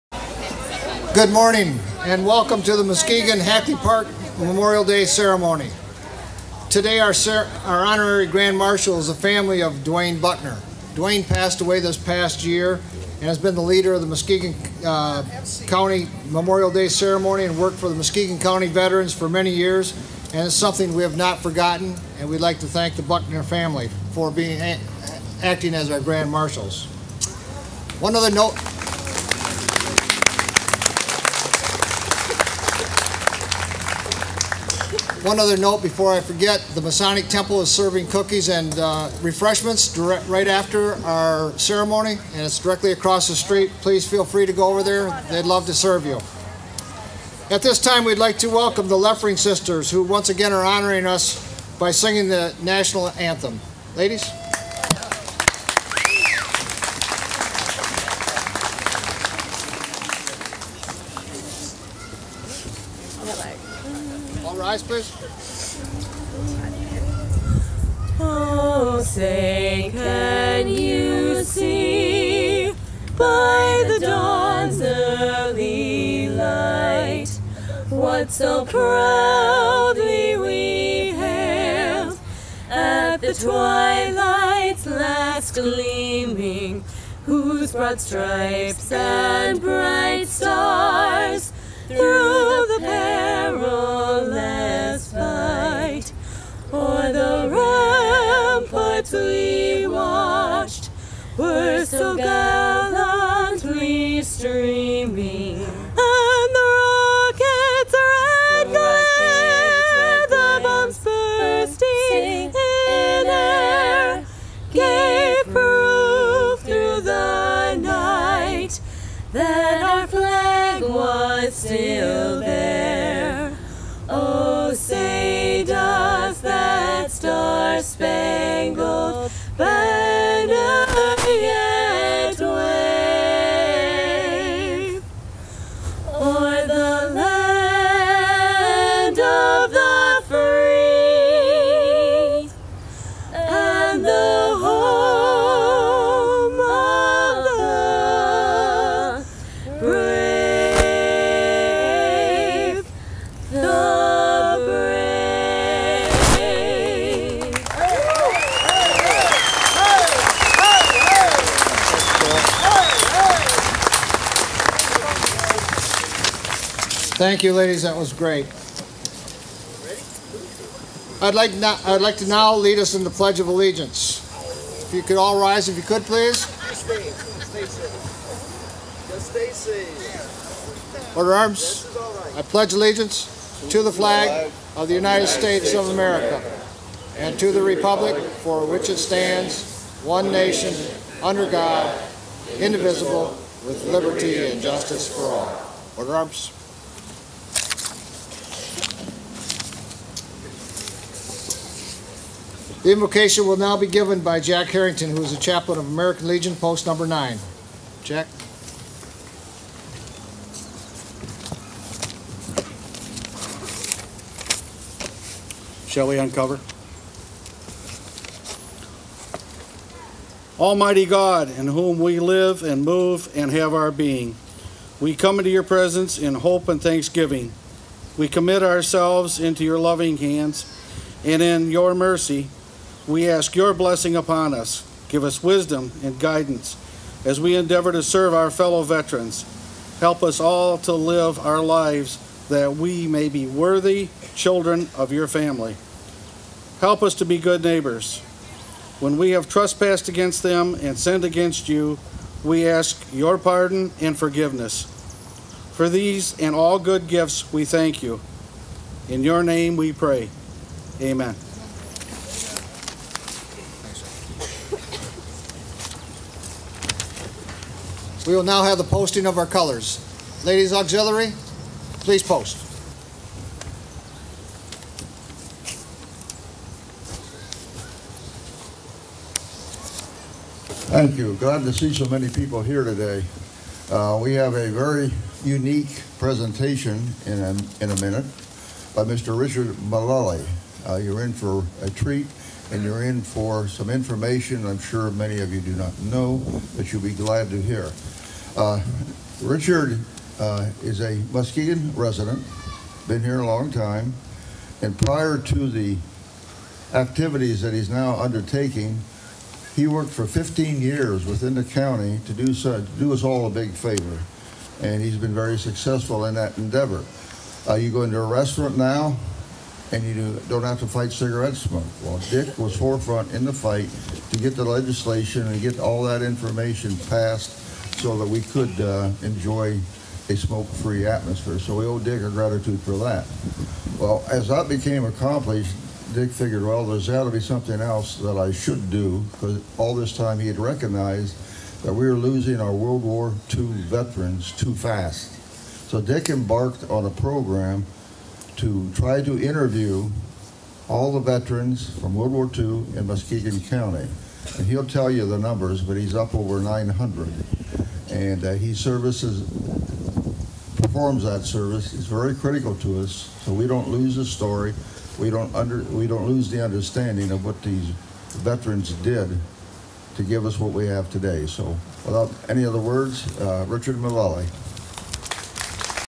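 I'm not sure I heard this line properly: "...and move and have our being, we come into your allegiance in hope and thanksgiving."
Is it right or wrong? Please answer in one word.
wrong.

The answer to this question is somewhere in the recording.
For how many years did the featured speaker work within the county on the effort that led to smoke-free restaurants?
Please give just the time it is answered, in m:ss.
5:10.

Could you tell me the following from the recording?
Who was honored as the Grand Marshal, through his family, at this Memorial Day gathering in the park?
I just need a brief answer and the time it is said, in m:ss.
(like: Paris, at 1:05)
Dwayne Buckner, at 0:09.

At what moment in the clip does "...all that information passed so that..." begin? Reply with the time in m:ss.
5:25.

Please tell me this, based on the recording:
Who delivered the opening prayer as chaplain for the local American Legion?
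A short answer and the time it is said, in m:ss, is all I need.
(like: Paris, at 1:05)
Jack Harrington, at 3:24.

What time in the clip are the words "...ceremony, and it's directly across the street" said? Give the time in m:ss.
0:41.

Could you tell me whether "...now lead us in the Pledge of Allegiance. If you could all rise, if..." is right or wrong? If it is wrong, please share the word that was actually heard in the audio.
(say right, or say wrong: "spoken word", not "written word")
right.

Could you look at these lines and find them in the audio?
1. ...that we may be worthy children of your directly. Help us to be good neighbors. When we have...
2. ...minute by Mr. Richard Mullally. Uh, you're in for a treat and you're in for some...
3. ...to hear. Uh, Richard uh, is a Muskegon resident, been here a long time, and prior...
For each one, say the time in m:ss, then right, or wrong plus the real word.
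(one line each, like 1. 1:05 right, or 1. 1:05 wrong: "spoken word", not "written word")
1. 4:02 wrong: "family", not "directly"
2. 4:47 right
3. 4:57 right.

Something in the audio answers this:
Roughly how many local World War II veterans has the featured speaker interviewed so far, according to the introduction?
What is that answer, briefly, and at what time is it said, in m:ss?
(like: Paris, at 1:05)
over 900, at 5:56.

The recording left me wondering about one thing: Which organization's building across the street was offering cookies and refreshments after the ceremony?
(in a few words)
Masonic Temple.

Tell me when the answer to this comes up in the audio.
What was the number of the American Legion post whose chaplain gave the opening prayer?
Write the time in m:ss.
3:27.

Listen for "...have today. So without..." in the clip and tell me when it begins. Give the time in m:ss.
6:10.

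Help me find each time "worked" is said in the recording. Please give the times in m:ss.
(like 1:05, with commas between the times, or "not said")
0:17, 5:09.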